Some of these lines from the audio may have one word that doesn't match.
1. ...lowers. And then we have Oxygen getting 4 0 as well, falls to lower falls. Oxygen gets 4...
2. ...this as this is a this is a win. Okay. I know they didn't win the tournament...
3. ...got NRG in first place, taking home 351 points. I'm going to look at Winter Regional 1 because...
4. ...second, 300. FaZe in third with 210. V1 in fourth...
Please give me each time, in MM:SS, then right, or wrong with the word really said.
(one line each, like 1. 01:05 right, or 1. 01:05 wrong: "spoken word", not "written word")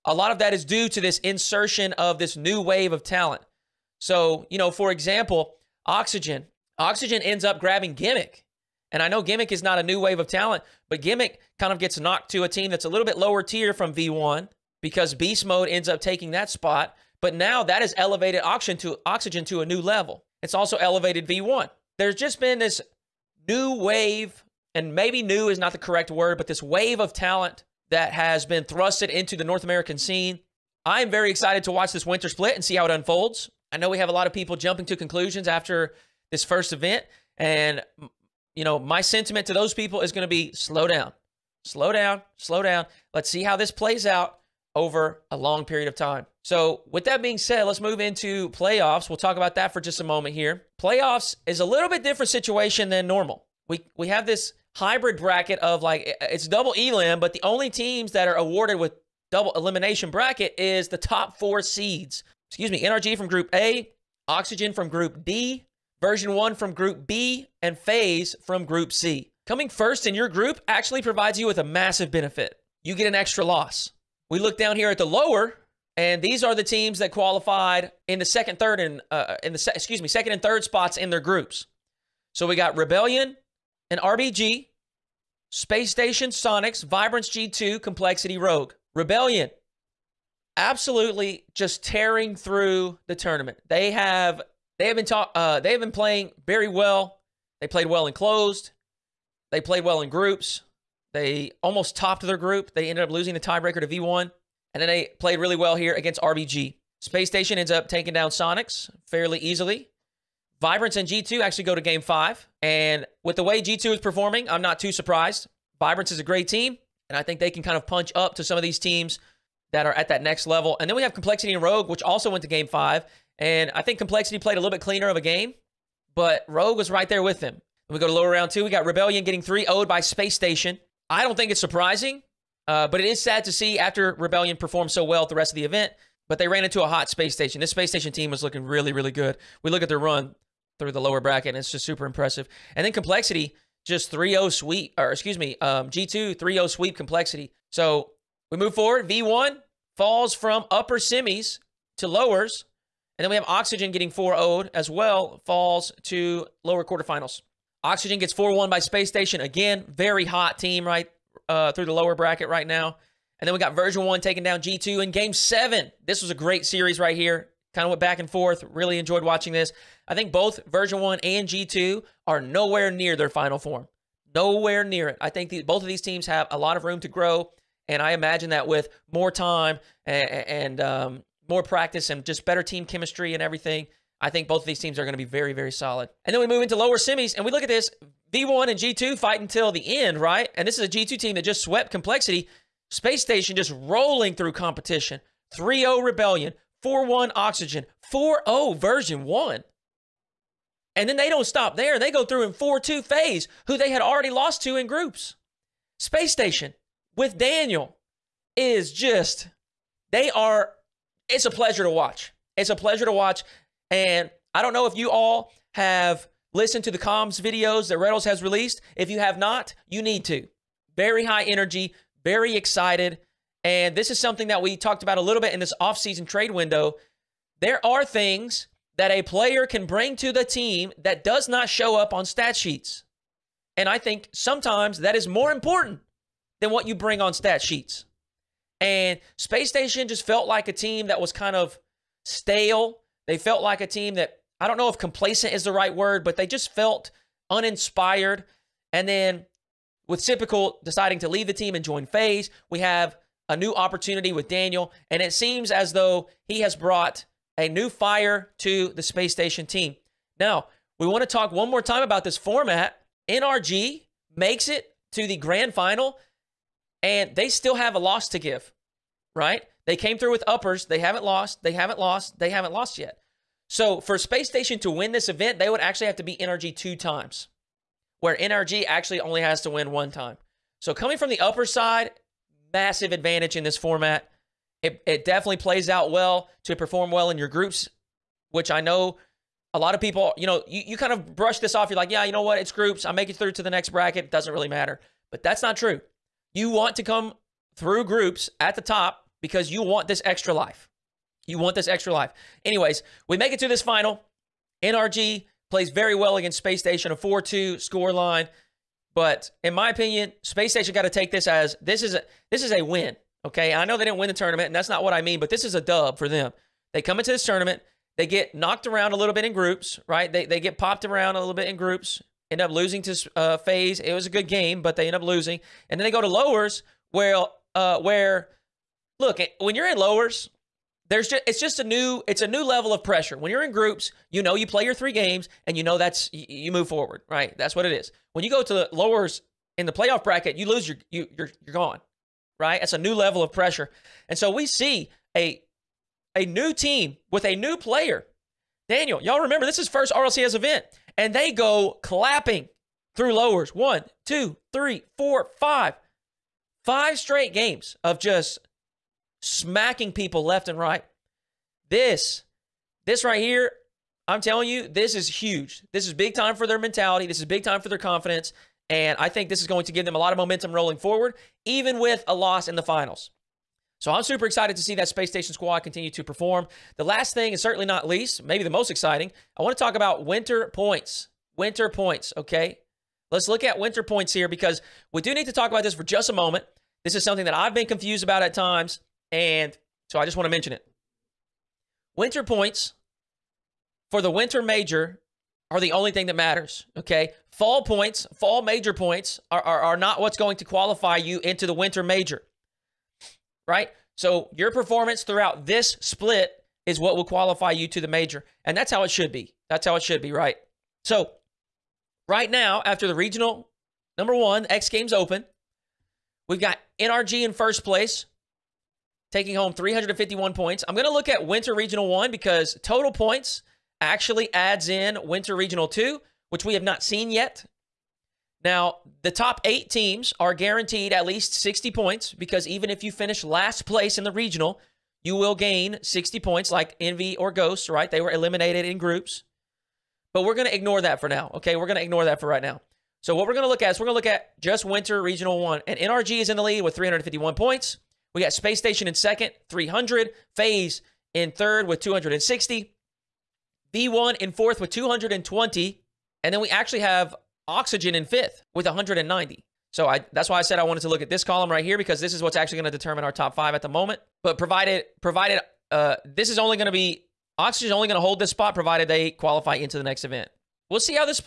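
1. 02:32 wrong: "quarterfinals", not "falls"
2. 05:11 right
3. 06:56 right
4. 07:29 wrong: "260", not "210".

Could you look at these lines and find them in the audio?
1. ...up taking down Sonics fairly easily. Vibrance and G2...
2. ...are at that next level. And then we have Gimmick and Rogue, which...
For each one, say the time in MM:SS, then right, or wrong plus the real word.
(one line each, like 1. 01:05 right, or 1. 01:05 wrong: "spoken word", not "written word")
1. 01:47 right
2. 01:59 wrong: "Complexity", not "Gimmick".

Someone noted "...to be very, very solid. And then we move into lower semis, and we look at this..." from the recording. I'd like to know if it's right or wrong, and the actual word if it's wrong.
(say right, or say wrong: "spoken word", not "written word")
right.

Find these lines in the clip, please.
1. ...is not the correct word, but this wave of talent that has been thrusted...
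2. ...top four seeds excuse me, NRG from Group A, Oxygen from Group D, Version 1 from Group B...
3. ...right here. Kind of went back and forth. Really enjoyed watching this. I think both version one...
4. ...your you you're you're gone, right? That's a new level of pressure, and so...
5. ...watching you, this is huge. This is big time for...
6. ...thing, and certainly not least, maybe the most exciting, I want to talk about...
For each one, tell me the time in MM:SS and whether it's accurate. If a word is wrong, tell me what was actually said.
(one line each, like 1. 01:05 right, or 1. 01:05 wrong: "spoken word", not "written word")
1. 00:25 right
2. 01:00 right
3. 02:46 right
4. 05:40 right
5. 06:04 wrong: "telling", not "watching"
6. 06:17 right.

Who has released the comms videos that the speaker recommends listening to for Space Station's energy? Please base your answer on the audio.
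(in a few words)
Reynolds.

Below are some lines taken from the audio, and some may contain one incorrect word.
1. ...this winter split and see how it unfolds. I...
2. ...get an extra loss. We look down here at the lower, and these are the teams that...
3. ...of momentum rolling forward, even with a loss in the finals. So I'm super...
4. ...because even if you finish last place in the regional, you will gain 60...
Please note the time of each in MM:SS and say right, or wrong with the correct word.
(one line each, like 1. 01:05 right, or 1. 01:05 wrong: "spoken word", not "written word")
1. 00:31 right
2. 01:12 right
3. 06:10 right
4. 07:12 right.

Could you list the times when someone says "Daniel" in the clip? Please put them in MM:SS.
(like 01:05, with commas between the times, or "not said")
03:27, 04:14, 05:48.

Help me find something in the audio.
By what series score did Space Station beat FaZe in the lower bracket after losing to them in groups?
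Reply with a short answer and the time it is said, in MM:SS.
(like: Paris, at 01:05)
4-2, at 03:22.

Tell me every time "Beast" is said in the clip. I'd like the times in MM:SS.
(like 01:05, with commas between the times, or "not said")
00:15.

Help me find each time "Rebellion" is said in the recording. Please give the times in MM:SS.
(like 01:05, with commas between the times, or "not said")
01:22, 01:28, 02:08, 02:14, 03:16.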